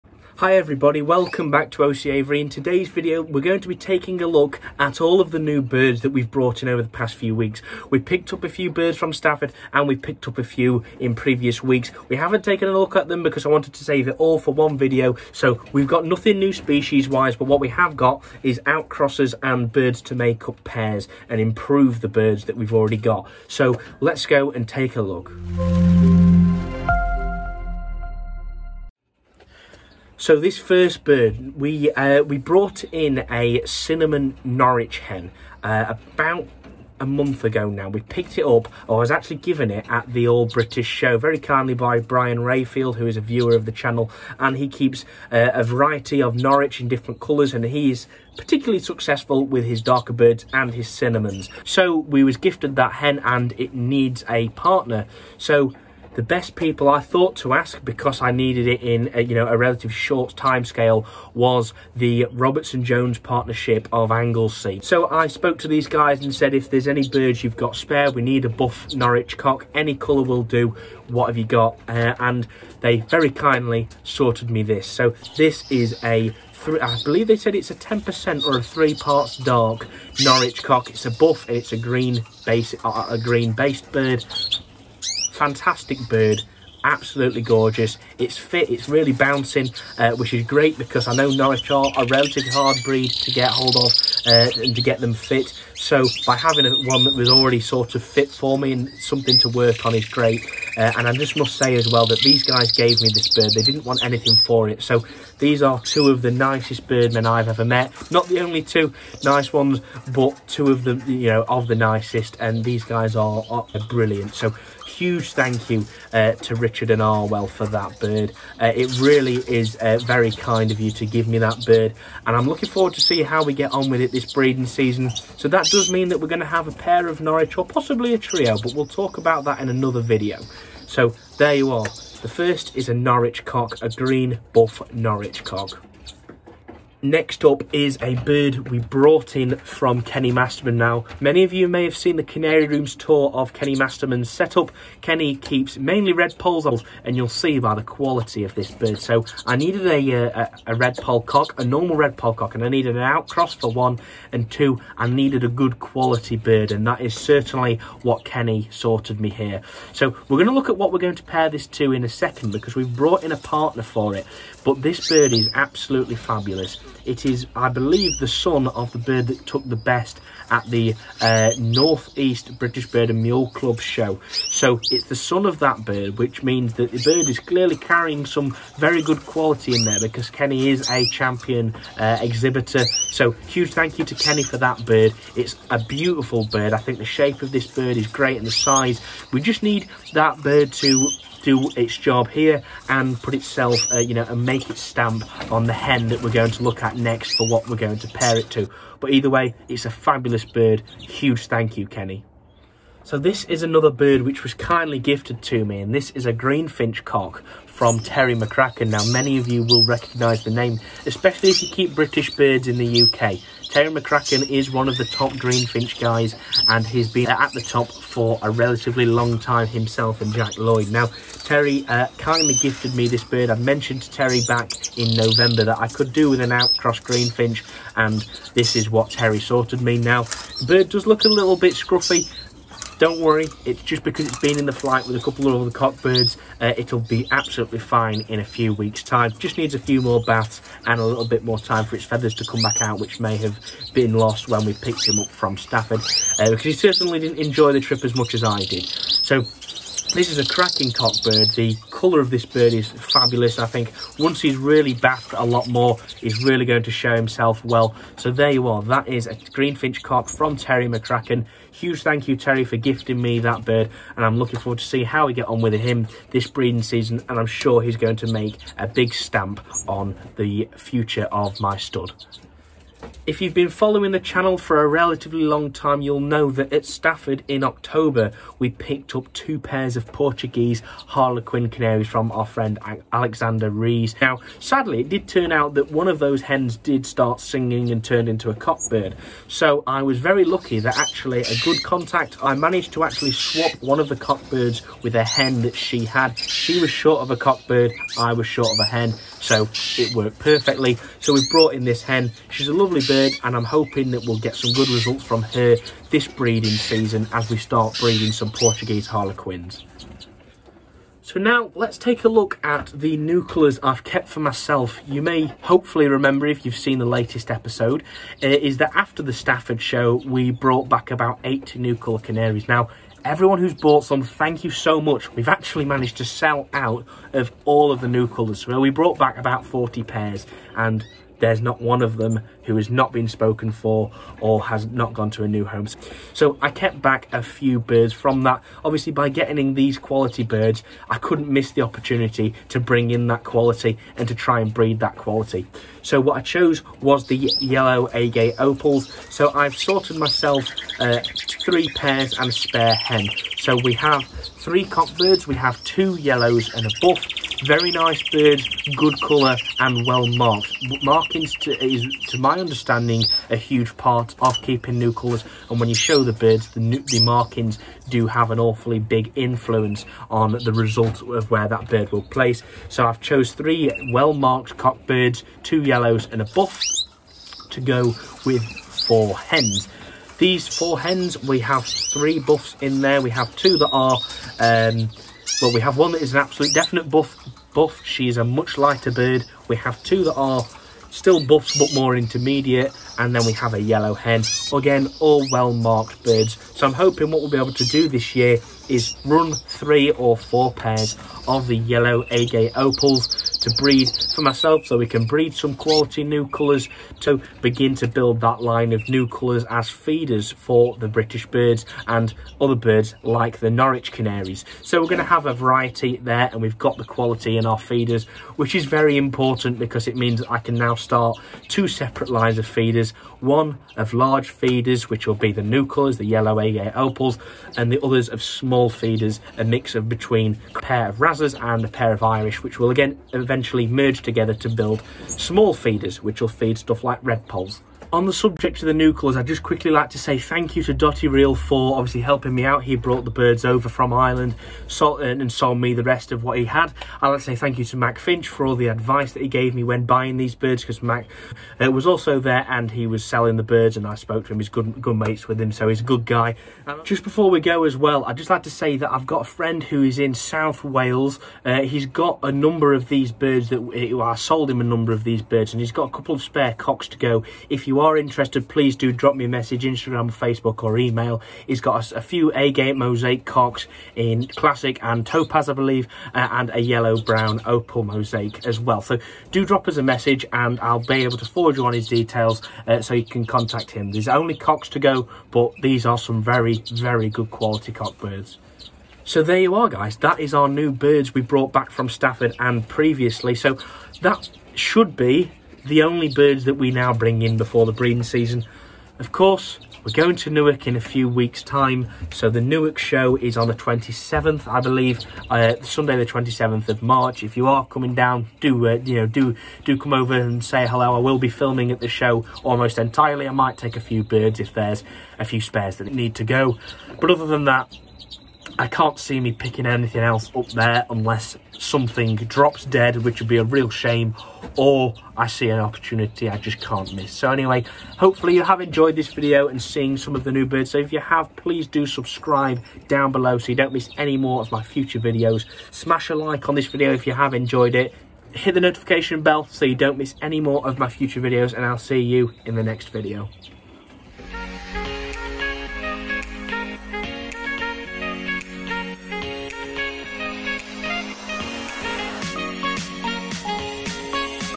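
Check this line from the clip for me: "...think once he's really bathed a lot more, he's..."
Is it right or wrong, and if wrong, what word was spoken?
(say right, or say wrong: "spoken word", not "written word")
right.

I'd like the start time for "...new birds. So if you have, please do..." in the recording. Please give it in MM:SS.
08:50.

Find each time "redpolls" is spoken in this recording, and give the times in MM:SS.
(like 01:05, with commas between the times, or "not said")
02:26, 02:30, 07:17.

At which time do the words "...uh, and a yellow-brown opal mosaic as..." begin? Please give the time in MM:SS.
07:56.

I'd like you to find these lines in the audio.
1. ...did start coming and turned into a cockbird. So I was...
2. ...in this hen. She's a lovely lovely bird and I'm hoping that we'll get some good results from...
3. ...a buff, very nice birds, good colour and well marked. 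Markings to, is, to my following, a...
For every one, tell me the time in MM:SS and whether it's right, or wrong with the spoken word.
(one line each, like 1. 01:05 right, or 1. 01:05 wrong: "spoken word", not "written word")
1. 04:46 wrong: "singing", not "coming"
2. 05:01 right
3. 05:56 wrong: "understanding", not "following".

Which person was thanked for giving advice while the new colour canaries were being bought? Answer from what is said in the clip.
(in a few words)
Mac Finch.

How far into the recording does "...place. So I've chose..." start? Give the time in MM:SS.
06:12.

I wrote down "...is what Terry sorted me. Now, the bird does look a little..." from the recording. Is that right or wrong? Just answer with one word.
right.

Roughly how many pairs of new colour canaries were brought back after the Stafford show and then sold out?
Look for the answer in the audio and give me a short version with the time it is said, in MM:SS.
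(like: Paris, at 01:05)
40, at 05:29.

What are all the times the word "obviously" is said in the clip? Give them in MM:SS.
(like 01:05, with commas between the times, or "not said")
05:38, 07:21.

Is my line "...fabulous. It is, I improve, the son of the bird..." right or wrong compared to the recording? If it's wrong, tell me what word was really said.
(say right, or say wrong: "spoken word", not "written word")
wrong: "believe", not "improve".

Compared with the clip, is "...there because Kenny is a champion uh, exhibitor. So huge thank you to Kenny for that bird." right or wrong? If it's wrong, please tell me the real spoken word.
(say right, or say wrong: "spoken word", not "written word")
right.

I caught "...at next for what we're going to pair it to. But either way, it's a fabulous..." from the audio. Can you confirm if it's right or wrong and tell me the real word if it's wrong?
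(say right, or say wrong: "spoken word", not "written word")
right.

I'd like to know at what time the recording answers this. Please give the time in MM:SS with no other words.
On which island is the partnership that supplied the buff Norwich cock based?
01:04.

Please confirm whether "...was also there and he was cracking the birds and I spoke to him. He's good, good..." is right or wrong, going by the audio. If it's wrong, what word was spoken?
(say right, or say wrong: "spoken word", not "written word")
wrong: "selling", not "cracking".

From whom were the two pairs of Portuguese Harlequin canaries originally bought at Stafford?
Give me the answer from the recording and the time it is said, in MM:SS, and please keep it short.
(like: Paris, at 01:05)
Alexander Rees, at 04:43.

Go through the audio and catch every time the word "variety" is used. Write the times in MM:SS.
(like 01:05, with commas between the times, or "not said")
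00:45, 06:55.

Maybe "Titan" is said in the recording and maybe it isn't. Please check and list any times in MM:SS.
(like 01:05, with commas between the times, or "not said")
not said.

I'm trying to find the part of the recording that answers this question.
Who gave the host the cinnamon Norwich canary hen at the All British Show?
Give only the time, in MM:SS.
00:42.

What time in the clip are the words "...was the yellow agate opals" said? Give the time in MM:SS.
05:47.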